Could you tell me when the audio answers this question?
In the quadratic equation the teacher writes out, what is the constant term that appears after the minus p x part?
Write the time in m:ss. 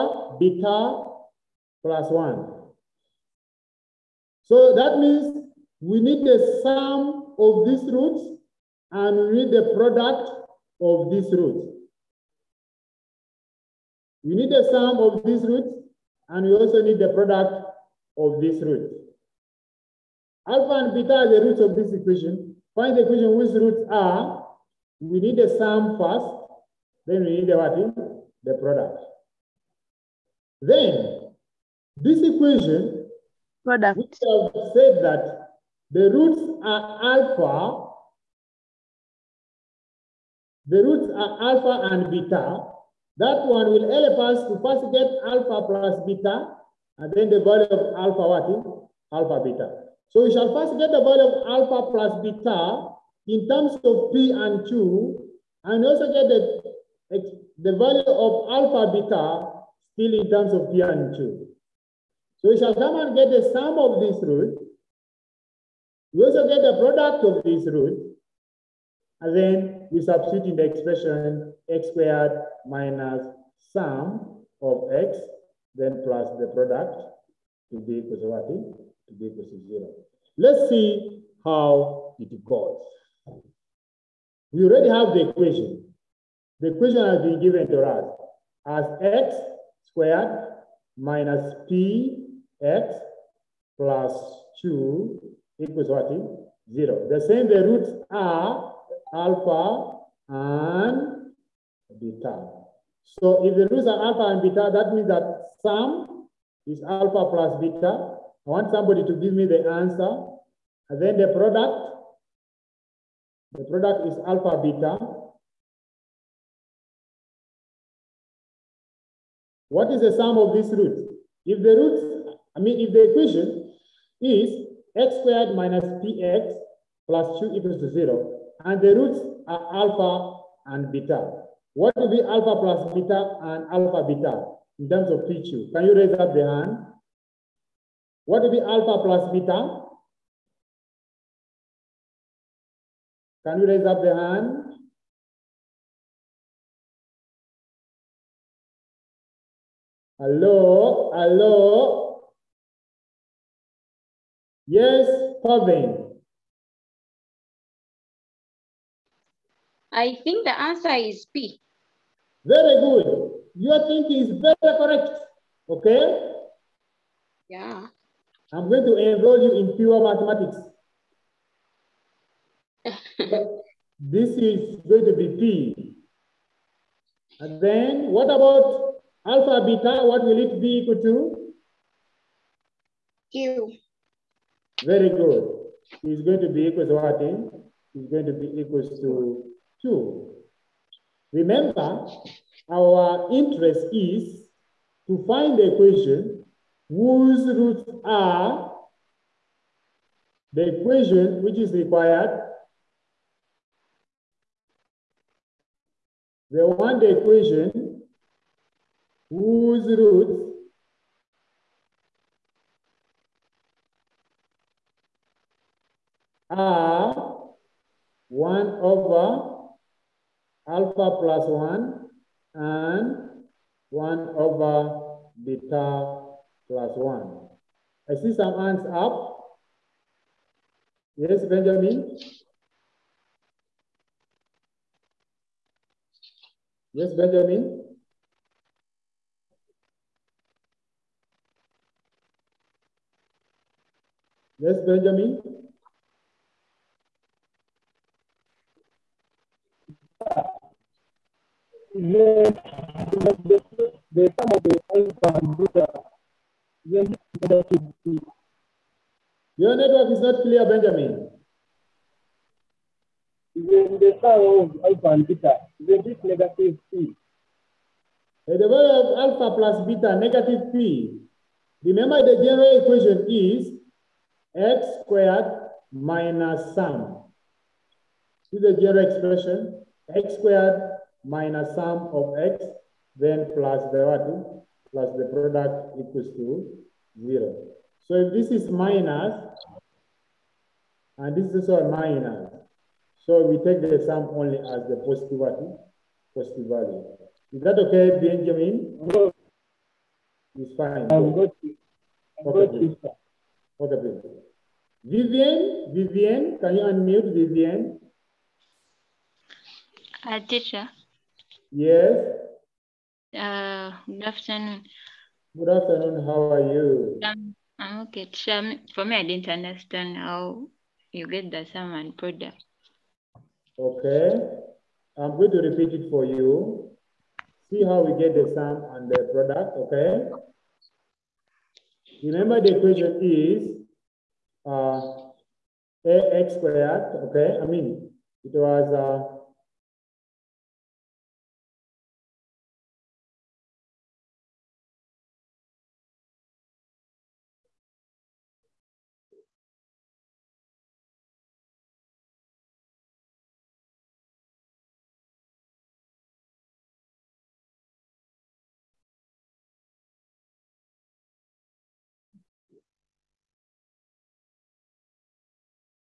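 1:30.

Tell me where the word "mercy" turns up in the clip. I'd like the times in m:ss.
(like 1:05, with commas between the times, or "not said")
not said.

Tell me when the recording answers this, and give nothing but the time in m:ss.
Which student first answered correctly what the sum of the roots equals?
2:34.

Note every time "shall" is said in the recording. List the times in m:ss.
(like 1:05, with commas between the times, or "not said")
0:50, 1:02.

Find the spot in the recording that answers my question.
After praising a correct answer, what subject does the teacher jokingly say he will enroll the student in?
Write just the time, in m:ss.
2:49.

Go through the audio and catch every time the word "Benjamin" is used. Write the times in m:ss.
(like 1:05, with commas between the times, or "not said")
3:51, 3:57, 4:04, 4:20, 4:58.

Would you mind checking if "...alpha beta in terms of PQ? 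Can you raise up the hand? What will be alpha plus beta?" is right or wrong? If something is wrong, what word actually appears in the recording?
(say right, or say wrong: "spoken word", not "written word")
right.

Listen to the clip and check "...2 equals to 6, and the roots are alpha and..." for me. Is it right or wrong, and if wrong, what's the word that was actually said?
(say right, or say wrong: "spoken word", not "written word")
wrong: "0", not "6".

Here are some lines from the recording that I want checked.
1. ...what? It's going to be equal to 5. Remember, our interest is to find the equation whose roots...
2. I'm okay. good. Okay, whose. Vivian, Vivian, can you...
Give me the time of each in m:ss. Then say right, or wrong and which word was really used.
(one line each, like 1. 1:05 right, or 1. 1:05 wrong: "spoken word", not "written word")
1. 3:06 wrong: "2", not "5"
2. 5:02 wrong: "please", not "whose".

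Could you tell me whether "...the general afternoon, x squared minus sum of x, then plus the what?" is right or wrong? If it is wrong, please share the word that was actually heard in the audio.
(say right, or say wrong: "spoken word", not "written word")
wrong: "expression", not "afternoon".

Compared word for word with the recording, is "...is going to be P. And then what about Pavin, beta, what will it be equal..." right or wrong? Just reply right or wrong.
wrong.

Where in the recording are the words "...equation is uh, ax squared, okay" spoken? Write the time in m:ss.
5:32.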